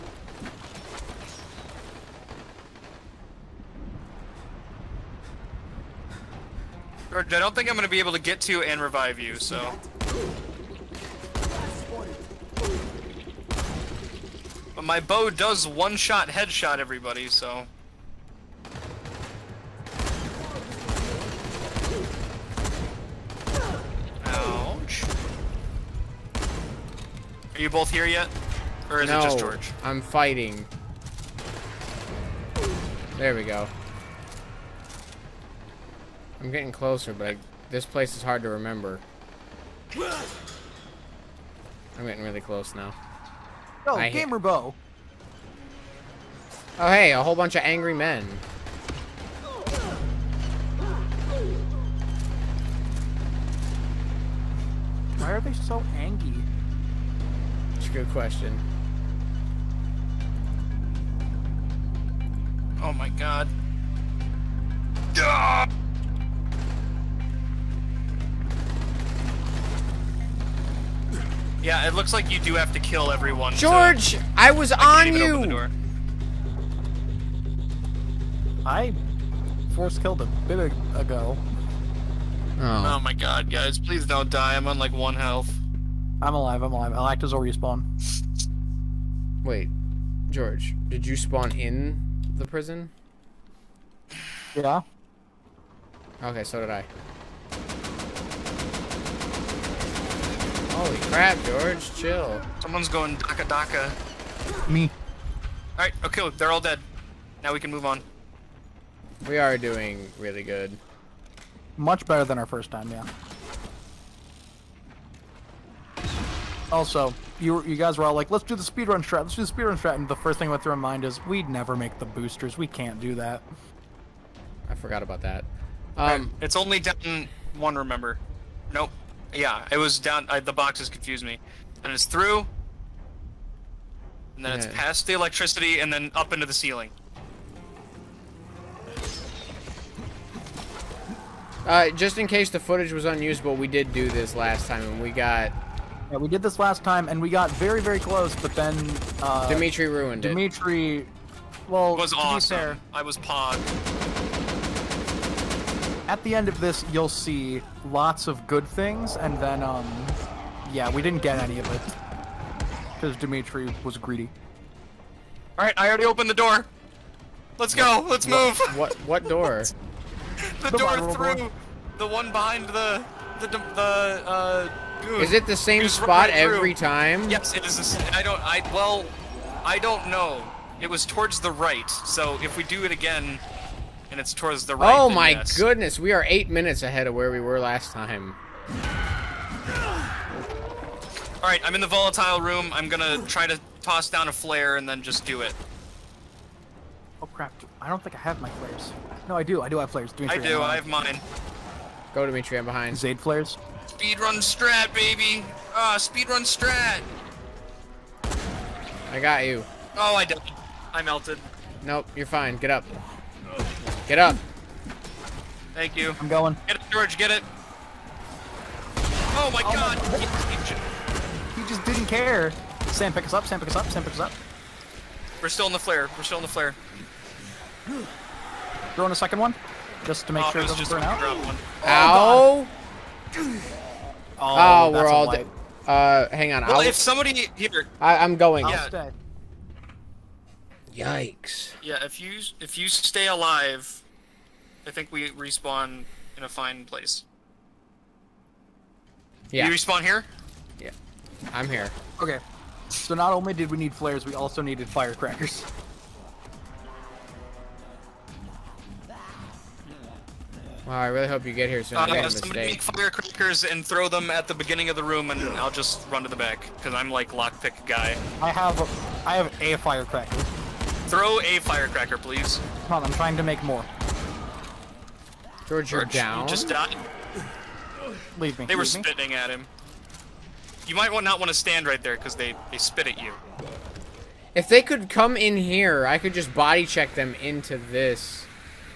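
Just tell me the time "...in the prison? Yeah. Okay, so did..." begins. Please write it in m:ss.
1:31.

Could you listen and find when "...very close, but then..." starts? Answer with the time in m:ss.
2:27.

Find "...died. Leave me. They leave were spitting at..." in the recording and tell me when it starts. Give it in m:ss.
4:36.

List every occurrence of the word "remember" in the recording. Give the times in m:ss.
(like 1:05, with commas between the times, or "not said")
0:38, 2:07.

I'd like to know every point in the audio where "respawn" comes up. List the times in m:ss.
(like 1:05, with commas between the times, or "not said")
1:27, 4:05, 4:09.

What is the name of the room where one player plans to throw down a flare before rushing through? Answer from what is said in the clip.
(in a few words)
volatile room.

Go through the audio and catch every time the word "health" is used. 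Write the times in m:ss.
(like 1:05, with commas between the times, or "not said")
1:25.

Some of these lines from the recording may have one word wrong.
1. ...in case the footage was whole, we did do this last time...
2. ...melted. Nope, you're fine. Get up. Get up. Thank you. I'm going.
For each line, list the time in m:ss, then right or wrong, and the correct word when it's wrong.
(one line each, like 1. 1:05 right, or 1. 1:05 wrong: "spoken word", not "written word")
1. 2:22 wrong: "unusable", not "whole"
2. 3:31 right.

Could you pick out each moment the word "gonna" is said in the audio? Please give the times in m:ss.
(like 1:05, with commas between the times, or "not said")
0:07, 3:12.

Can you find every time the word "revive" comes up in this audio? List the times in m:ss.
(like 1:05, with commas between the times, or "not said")
0:08.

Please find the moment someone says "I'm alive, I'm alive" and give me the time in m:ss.
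1:26.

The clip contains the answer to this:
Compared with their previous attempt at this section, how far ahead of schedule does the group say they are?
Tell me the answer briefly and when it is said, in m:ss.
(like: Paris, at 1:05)
8 minutes, at 3:06.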